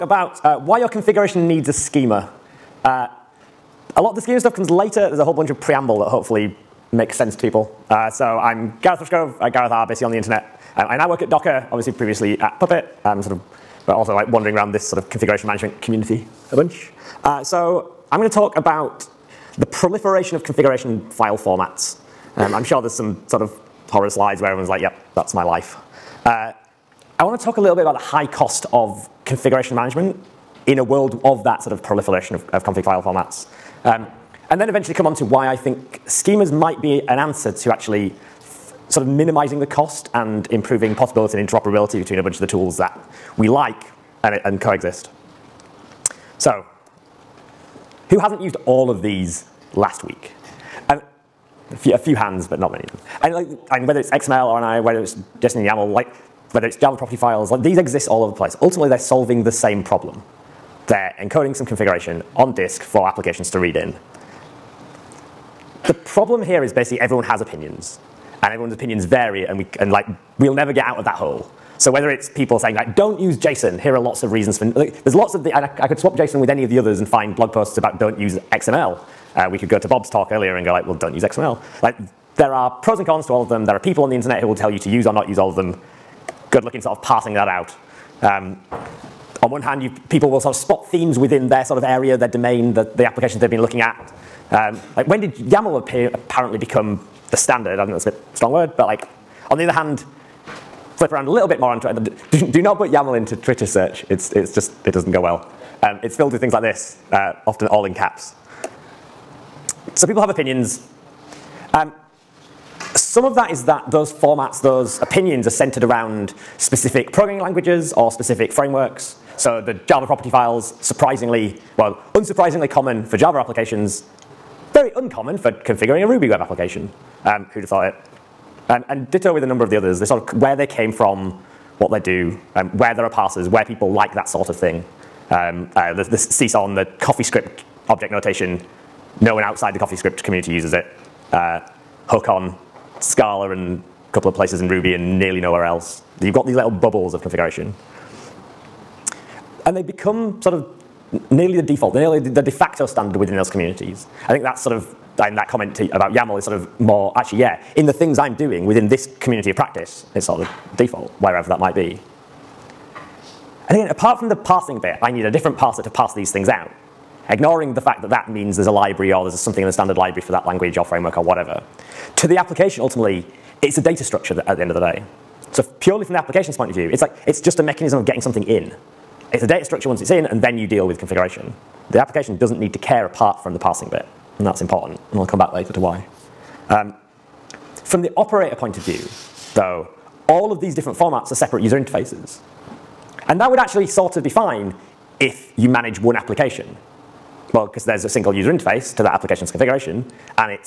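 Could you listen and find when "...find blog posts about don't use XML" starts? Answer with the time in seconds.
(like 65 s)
77 s.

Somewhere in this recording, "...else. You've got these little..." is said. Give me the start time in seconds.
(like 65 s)
145 s.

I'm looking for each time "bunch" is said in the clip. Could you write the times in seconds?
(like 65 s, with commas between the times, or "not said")
5 s, 16 s, 42 s.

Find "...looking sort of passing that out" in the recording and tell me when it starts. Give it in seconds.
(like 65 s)
86 s.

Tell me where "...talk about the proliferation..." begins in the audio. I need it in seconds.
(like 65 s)
18 s.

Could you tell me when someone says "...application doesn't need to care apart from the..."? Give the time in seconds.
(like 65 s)
181 s.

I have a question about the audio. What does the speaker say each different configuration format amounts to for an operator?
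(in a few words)
separate user interfaces.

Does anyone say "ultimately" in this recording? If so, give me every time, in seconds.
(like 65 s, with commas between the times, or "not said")
58 s, 172 s.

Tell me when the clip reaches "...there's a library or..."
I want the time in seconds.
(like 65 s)
168 s.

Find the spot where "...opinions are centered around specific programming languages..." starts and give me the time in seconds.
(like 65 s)
115 s.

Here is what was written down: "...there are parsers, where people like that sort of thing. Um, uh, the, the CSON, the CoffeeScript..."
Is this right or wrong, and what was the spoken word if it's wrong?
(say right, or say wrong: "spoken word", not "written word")
right.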